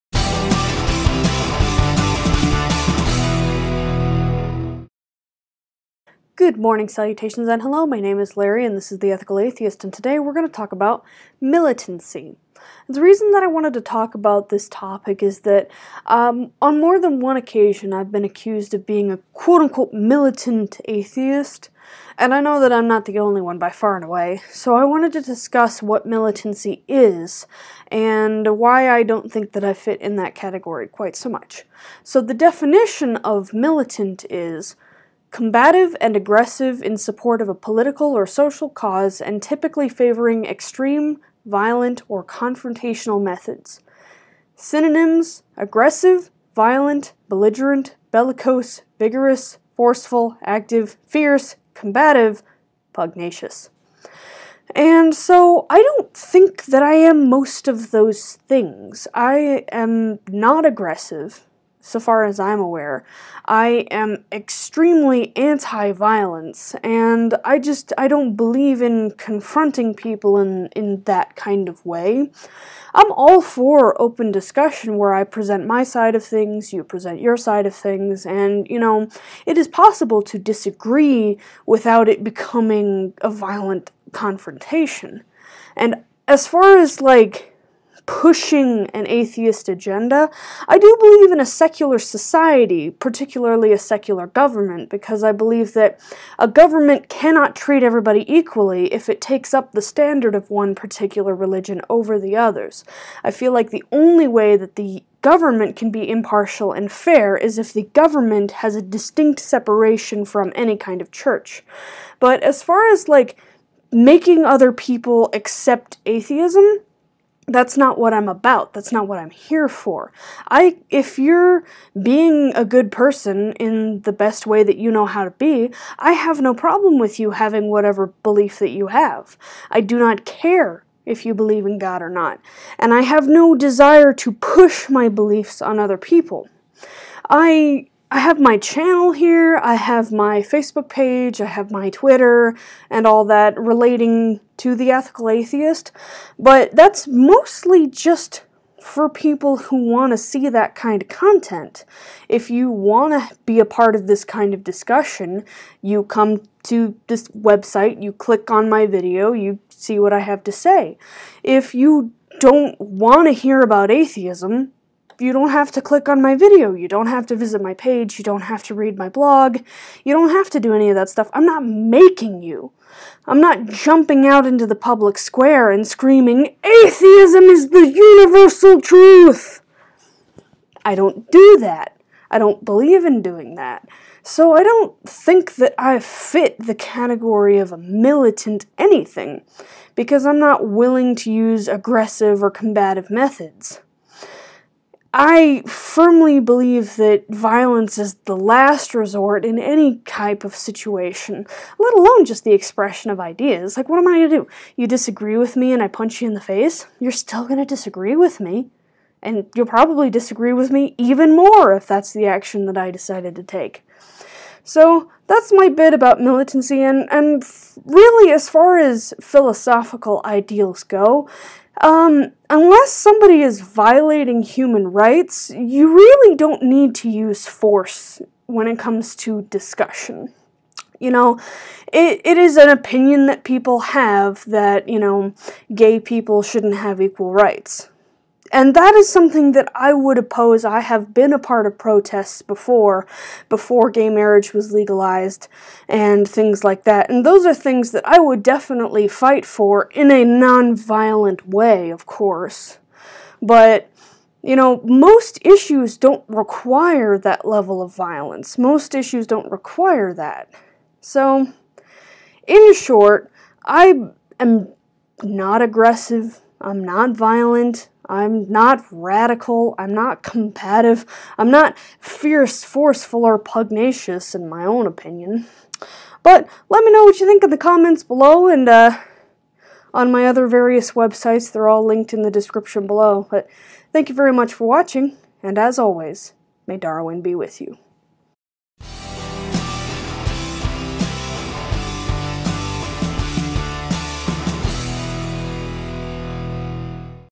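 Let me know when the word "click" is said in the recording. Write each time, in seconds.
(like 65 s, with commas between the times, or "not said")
158 s, 165 s.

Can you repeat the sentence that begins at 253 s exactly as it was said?
But you know, most issues don't require that level of violence.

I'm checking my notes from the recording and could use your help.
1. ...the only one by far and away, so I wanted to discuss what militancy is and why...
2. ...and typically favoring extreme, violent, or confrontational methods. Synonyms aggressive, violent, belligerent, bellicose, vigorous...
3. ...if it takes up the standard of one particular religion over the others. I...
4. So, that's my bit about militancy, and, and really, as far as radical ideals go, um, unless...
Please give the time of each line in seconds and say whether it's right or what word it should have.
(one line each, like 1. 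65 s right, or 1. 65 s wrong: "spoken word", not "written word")
1. 23 s right
2. 39 s right
3. 98 s right
4. 214 s wrong: "philosophical", not "radical".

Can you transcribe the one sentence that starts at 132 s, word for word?
And I have no desire to push my beliefs on other people.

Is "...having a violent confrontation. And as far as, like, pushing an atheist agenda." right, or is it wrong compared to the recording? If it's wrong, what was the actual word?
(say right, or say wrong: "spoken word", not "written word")
wrong: "becoming", not "having".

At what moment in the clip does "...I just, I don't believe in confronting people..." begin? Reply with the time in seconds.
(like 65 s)
67 s.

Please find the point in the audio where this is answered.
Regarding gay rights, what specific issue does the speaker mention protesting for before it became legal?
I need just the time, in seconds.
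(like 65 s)
243 s.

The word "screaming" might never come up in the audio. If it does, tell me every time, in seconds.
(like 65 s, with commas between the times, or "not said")
175 s.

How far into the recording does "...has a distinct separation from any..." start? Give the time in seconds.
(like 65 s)
108 s.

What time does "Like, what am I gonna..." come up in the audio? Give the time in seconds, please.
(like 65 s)
203 s.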